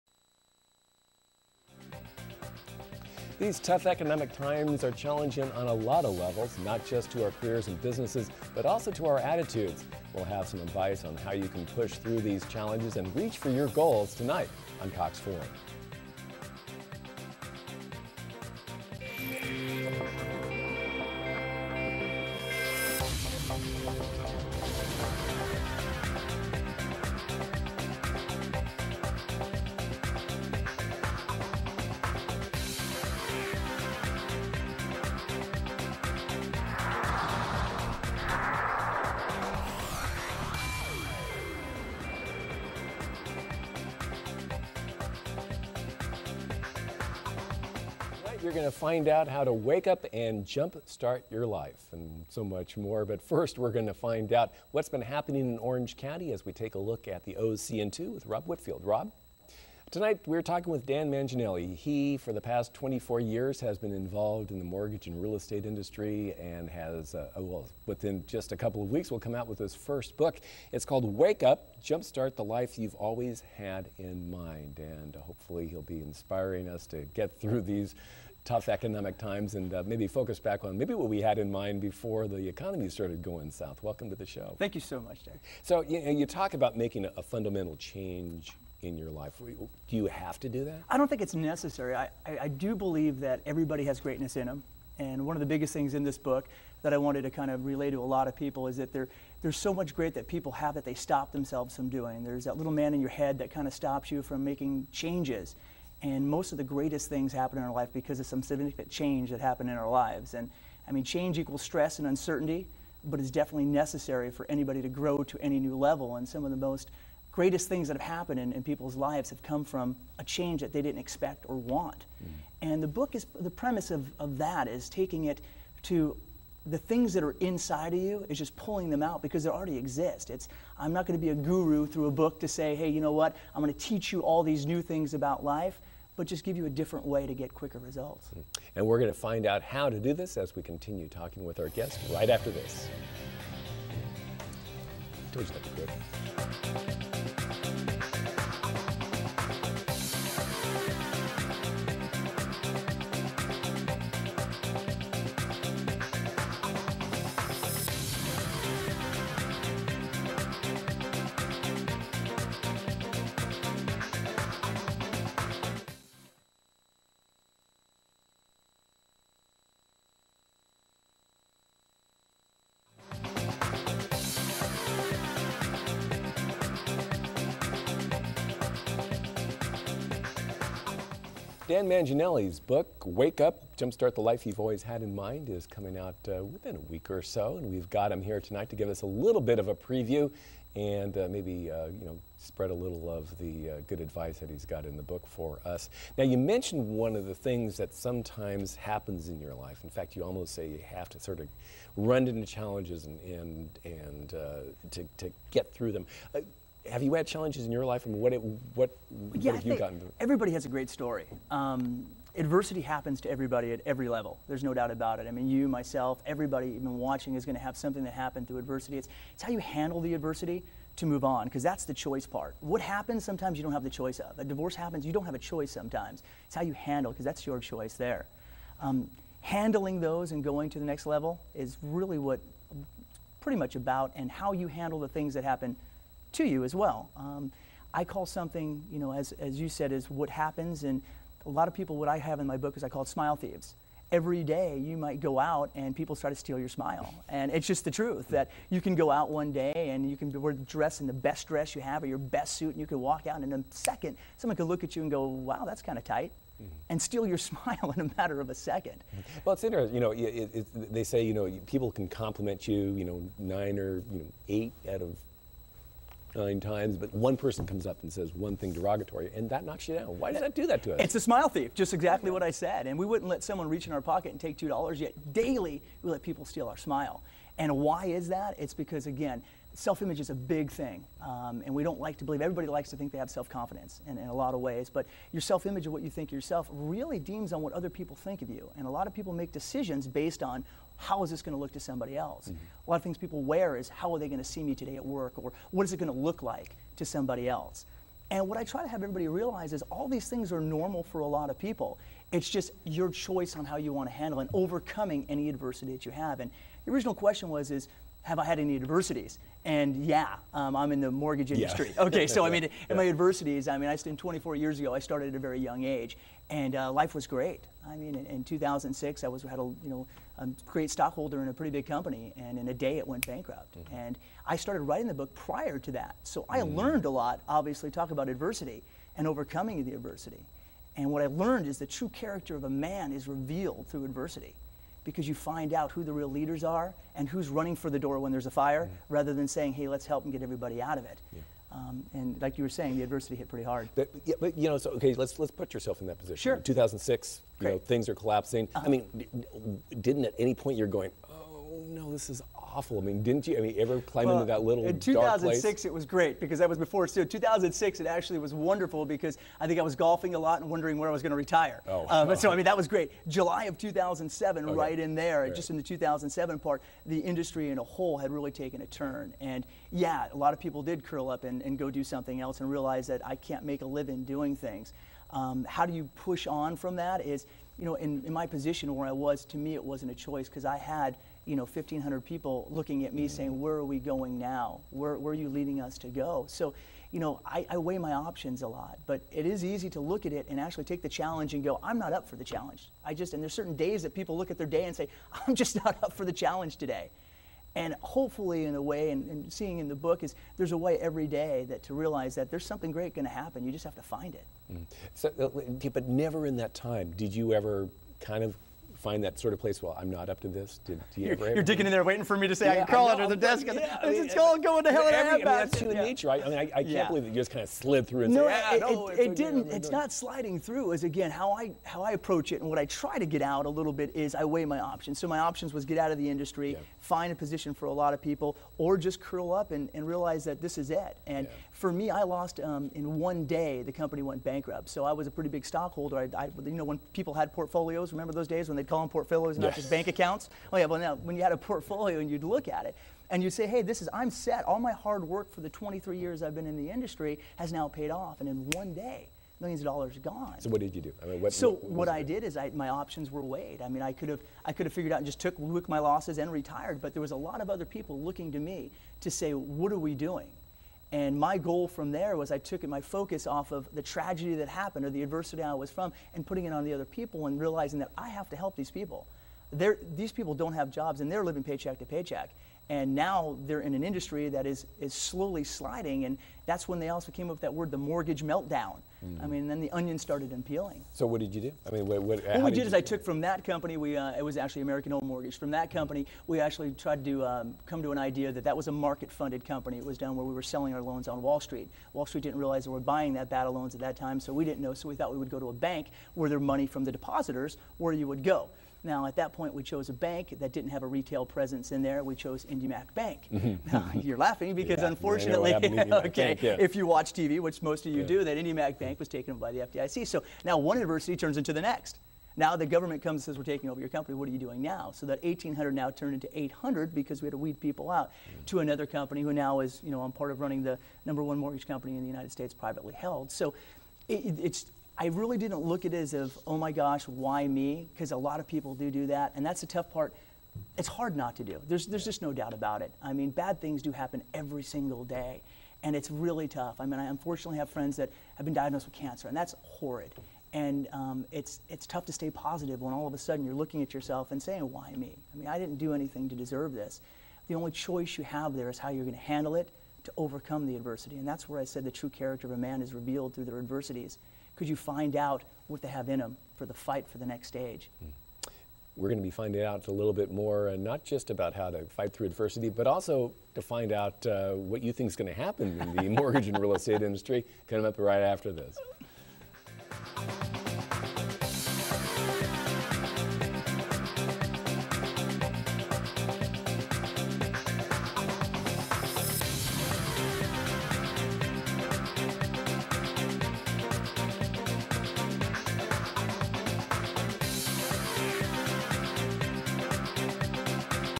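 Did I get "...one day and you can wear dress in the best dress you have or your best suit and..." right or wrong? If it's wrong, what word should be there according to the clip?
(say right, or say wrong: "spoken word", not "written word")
right.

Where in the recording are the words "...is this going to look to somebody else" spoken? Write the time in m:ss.
4:51.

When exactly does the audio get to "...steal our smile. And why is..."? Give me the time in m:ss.
4:36.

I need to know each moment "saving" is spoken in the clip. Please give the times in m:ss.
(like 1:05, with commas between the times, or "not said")
not said.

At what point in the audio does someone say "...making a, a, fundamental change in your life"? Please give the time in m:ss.
1:26.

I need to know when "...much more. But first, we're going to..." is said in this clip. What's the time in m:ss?
0:52.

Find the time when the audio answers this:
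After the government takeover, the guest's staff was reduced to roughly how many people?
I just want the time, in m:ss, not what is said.
8:36.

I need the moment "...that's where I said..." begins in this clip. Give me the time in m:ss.
9:11.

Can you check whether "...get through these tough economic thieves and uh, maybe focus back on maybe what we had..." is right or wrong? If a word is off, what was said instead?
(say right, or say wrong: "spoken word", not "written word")
wrong: "times", not "thieves".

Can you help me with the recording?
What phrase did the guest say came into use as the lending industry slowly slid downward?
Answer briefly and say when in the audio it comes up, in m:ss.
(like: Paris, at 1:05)
mortgage meltdown, at 7:57.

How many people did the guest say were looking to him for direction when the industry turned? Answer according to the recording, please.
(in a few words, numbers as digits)
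1,500.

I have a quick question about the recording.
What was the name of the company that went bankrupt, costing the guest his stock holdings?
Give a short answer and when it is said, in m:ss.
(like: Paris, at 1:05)
American Home Mortgage, at 8:04.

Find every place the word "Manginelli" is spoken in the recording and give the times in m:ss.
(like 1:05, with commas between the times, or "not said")
1:01, 3:01.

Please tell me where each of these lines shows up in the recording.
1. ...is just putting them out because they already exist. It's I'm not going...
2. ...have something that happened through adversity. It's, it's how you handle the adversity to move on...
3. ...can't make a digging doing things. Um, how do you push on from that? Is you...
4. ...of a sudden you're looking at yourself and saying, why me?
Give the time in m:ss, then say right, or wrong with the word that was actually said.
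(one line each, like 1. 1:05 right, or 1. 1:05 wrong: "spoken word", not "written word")
1. 2:08 wrong: "pulling", not "putting"
2. 3:37 right
3. 6:13 wrong: "living", not "digging"
4. 9:03 right.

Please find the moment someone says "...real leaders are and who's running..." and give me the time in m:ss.
5:36.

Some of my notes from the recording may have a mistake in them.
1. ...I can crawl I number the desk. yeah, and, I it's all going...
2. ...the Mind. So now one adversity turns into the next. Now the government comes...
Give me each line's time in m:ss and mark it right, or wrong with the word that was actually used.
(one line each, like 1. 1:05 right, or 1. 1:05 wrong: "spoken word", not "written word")
1. 6:52 wrong: "under", not "number"
2. 8:29 wrong: "FDIC", not "Mind".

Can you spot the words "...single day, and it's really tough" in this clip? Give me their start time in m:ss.
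8:54.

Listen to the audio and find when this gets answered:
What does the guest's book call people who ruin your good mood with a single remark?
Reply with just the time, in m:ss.
4:03.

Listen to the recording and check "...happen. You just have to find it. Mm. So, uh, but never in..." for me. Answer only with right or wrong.
right.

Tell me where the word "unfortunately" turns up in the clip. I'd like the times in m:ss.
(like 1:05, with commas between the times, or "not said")
8:25, 8:57.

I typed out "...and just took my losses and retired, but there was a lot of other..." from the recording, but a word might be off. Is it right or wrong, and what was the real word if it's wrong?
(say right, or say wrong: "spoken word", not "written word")
right.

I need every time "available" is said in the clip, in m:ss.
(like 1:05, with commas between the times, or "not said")
not said.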